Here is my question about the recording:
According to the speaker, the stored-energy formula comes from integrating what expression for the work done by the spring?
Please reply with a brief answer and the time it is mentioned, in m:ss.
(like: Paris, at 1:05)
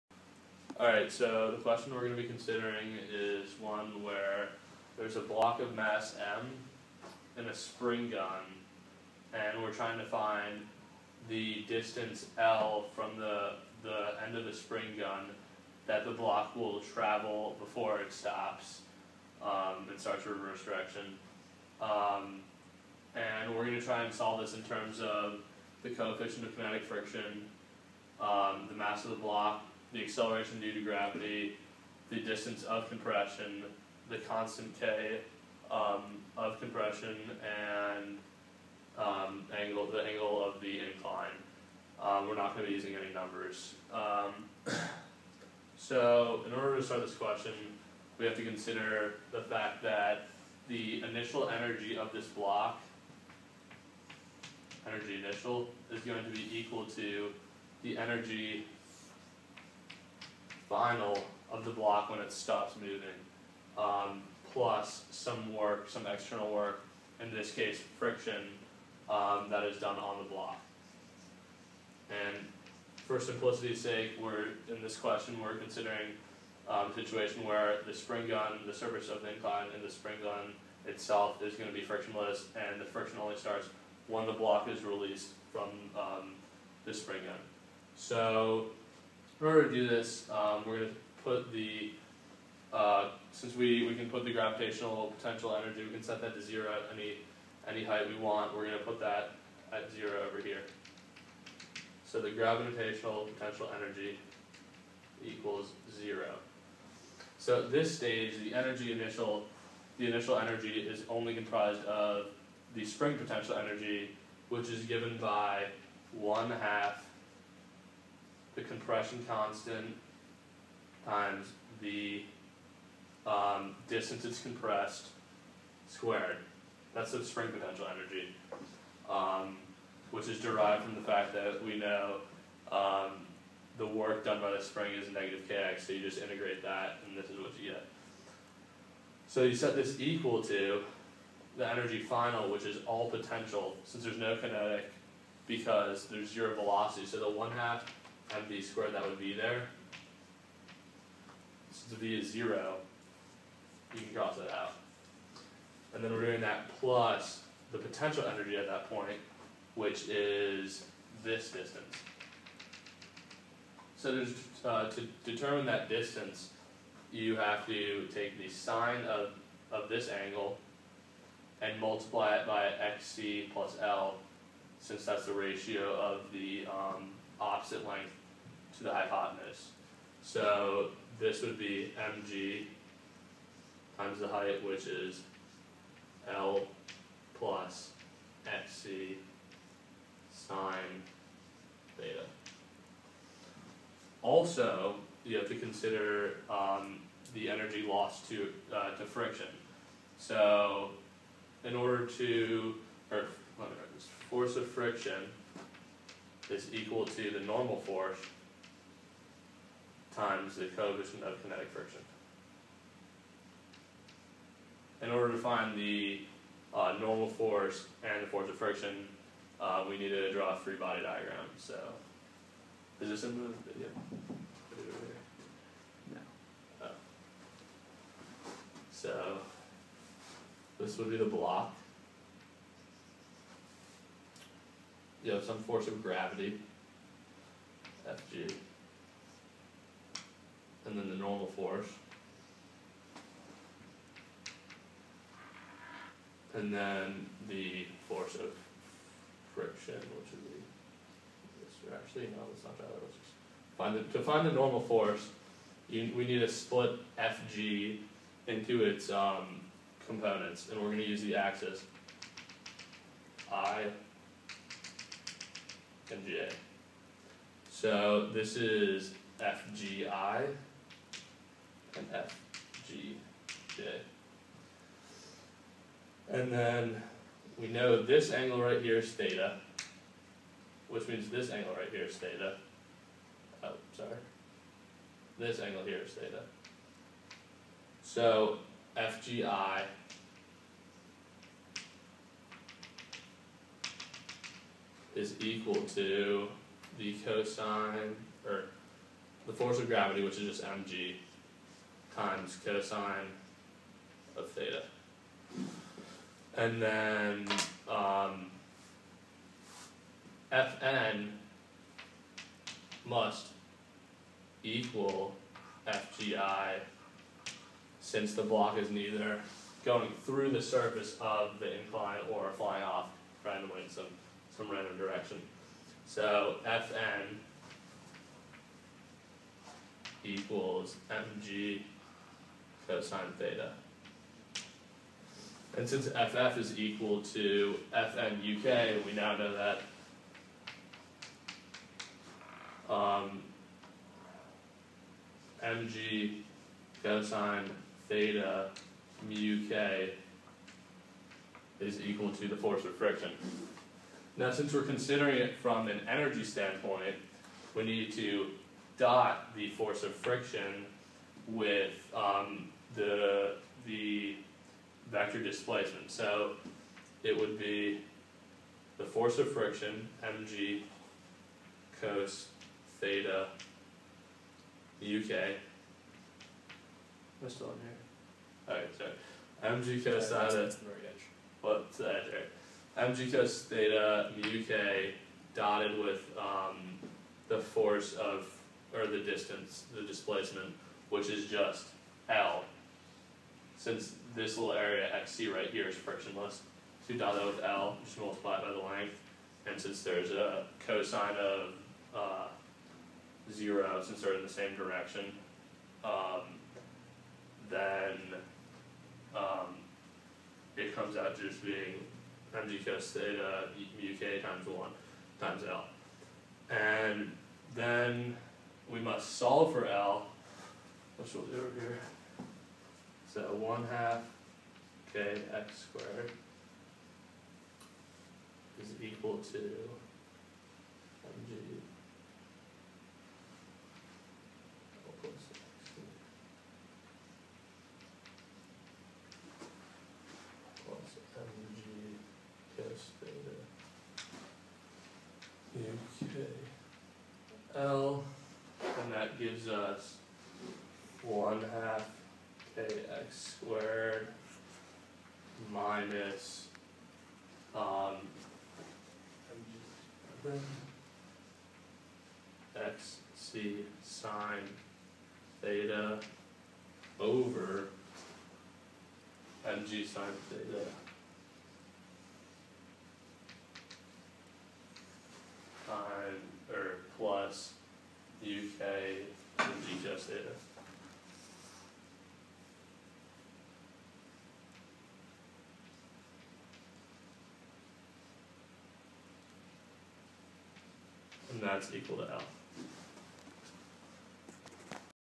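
negative kx, at 2:15.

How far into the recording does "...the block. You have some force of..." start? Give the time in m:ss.
3:51.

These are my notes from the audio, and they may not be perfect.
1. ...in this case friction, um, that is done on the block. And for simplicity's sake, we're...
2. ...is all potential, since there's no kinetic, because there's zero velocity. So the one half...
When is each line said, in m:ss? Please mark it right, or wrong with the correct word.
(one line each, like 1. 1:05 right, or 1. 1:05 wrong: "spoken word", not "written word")
1. 1:07 right
2. 2:22 right.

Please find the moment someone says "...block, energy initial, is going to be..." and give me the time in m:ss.
0:52.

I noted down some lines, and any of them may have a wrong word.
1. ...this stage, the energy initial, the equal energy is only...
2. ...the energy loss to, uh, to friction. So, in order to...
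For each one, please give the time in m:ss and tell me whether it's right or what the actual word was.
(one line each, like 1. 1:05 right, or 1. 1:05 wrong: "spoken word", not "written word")
1. 1:47 wrong: "initial", not "equal"
2. 3:17 right.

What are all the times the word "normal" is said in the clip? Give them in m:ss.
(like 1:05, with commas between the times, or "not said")
3:27, 3:36, 4:01, 4:14.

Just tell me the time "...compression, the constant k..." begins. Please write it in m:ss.
0:32.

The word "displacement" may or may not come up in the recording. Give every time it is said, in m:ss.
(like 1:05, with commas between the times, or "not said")
6:05, 6:30.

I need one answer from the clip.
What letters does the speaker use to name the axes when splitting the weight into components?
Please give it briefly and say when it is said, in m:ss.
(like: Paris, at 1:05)
I and J, at 4:23.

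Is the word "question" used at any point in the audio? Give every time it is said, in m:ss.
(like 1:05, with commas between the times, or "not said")
0:01, 0:47, 1:14.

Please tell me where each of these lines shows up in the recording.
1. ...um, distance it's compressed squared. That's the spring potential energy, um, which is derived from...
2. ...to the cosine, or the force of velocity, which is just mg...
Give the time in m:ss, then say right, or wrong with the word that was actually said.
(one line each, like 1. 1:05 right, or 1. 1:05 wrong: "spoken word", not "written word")
1. 2:03 right
2. 4:55 wrong: "gravity", not "velocity".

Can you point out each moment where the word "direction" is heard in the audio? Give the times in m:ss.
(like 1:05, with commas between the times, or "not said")
0:20, 5:24, 6:44.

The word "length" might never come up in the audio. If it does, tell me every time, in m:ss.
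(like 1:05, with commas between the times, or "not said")
2:57, 6:38.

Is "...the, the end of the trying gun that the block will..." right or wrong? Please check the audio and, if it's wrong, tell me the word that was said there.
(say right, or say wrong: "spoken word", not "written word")
wrong: "spring", not "trying".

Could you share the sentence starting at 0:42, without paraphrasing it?
Um, we're not going to be using any numbers.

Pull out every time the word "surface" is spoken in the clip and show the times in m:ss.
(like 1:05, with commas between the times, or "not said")
1:18, 5:20.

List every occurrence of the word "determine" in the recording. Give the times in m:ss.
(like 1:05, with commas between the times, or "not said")
2:45.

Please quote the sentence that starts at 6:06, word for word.
So it would be the force of friction, mg cos theta uk.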